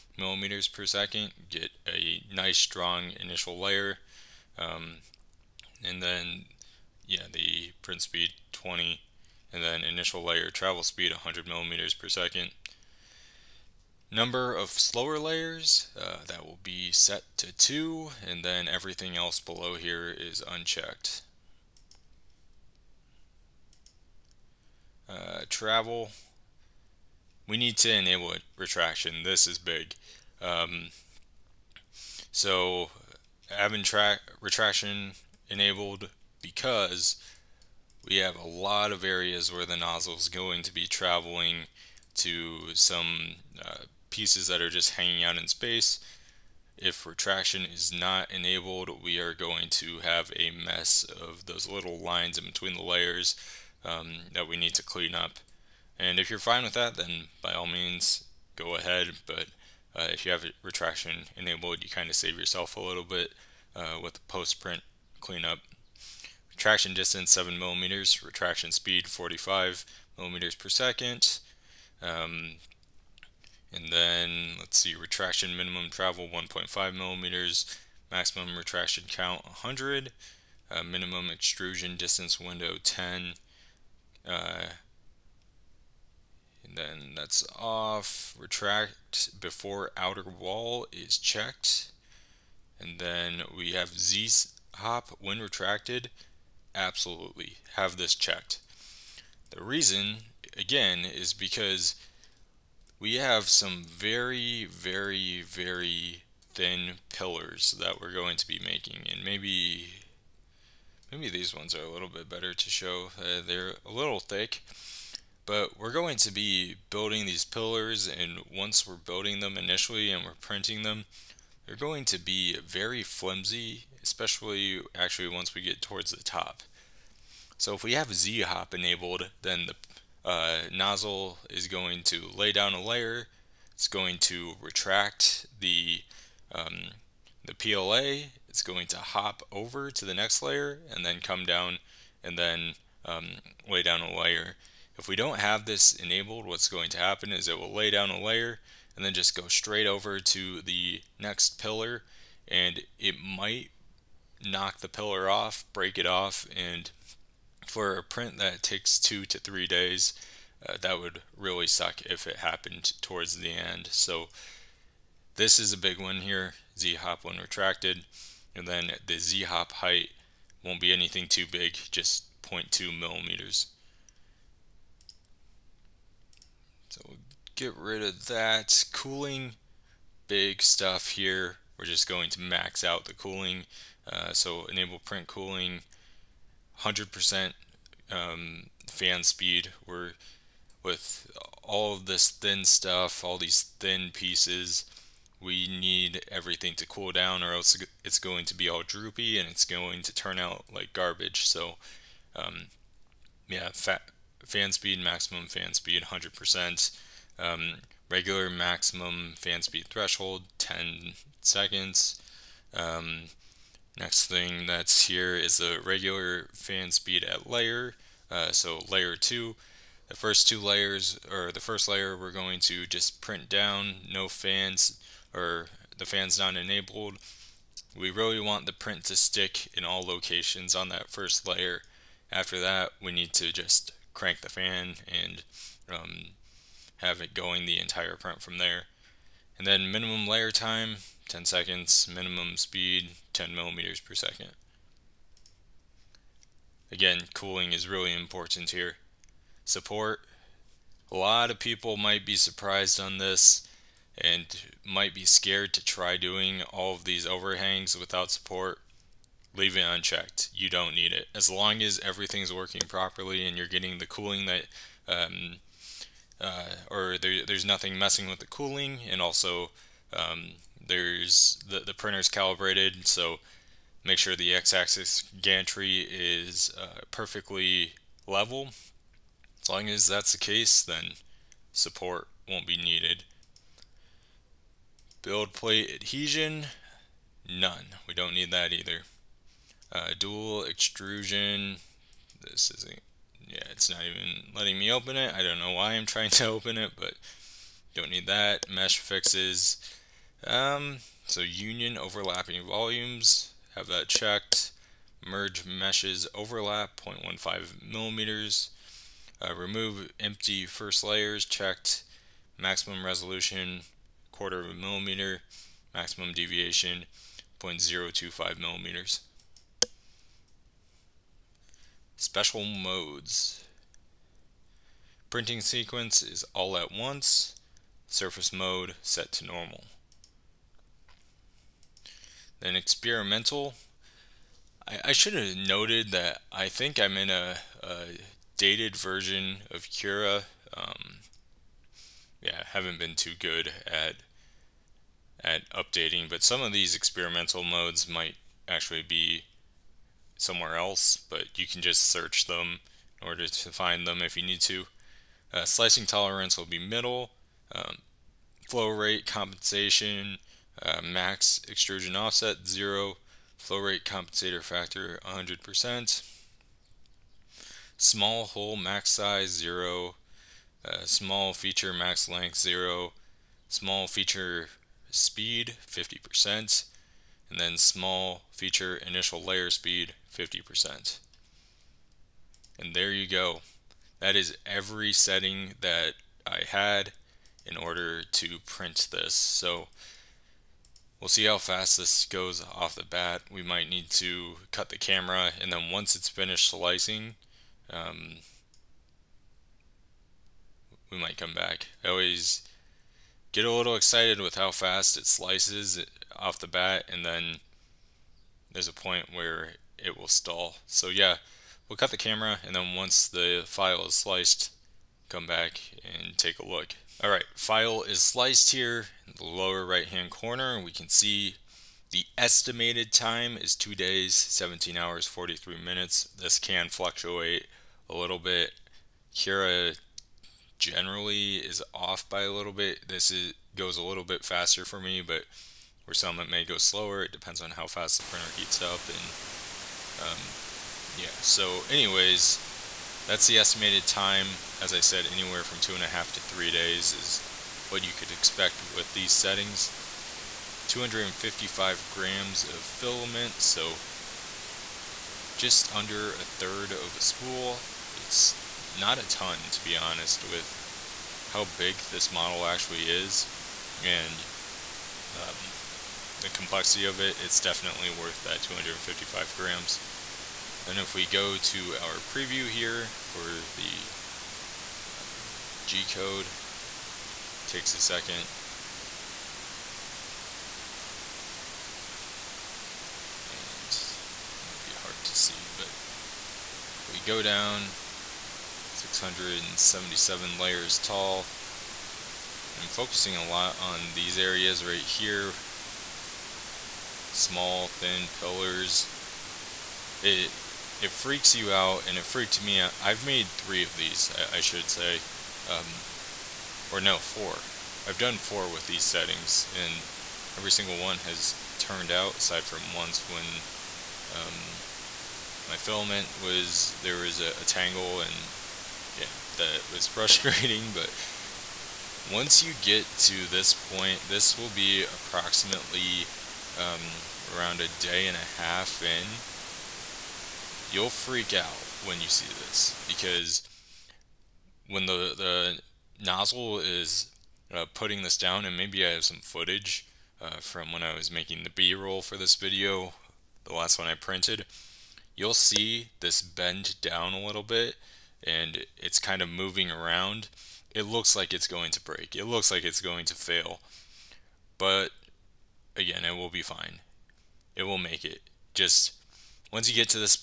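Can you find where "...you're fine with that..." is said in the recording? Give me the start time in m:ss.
0:56.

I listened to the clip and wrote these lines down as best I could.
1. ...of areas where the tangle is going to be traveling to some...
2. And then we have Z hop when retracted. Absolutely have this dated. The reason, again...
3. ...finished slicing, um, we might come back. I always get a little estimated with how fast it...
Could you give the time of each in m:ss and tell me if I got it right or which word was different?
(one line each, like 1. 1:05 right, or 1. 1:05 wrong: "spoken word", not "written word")
1. 0:38 wrong: "nozzle", not "tangle"
2. 1:32 wrong: "checked", not "dated"
3. 6:36 wrong: "excited", not "estimated".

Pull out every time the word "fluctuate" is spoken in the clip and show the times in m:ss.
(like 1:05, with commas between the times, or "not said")
7:06.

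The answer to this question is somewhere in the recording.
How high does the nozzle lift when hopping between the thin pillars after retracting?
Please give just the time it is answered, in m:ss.
2:51.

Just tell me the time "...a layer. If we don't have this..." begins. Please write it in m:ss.
2:24.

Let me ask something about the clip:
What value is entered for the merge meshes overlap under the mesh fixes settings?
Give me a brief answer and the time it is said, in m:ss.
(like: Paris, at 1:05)
0.15 millimeters, at 5:05.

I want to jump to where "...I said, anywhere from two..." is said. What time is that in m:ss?
7:24.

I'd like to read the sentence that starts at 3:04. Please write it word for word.
Uh, so enable print cooling, 100% um, fan speed.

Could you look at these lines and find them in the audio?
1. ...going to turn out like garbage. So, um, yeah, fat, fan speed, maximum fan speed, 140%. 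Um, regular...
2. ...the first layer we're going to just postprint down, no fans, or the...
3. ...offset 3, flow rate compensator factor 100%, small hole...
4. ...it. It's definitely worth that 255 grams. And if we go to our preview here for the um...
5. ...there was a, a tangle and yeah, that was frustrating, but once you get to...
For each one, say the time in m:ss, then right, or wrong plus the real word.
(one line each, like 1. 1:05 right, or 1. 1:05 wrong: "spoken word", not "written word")
1. 3:19 wrong: "100", not "140"
2. 3:41 wrong: "print", not "postprint"
3. 6:02 wrong: "0", not "3"
4. 7:47 right
5. 8:37 right.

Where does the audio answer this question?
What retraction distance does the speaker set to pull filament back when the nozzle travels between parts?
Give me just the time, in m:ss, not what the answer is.
1:06.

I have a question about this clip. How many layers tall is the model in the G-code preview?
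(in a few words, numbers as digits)
677.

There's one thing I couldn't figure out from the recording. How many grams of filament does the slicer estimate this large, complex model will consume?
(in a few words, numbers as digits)
255 grams.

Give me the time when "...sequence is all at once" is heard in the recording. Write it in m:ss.
5:25.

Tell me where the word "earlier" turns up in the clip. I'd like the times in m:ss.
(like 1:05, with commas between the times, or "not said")
not said.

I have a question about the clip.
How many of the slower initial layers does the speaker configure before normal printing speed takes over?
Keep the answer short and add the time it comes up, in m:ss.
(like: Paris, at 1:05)
2, at 0:14.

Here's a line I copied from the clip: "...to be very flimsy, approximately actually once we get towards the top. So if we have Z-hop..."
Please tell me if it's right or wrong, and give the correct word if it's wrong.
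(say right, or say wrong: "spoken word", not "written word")
wrong: "especially", not "approximately".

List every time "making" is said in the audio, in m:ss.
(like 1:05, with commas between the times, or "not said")
1:48, 9:01.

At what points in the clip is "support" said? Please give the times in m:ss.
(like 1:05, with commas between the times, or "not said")
4:09, 4:18, 4:41.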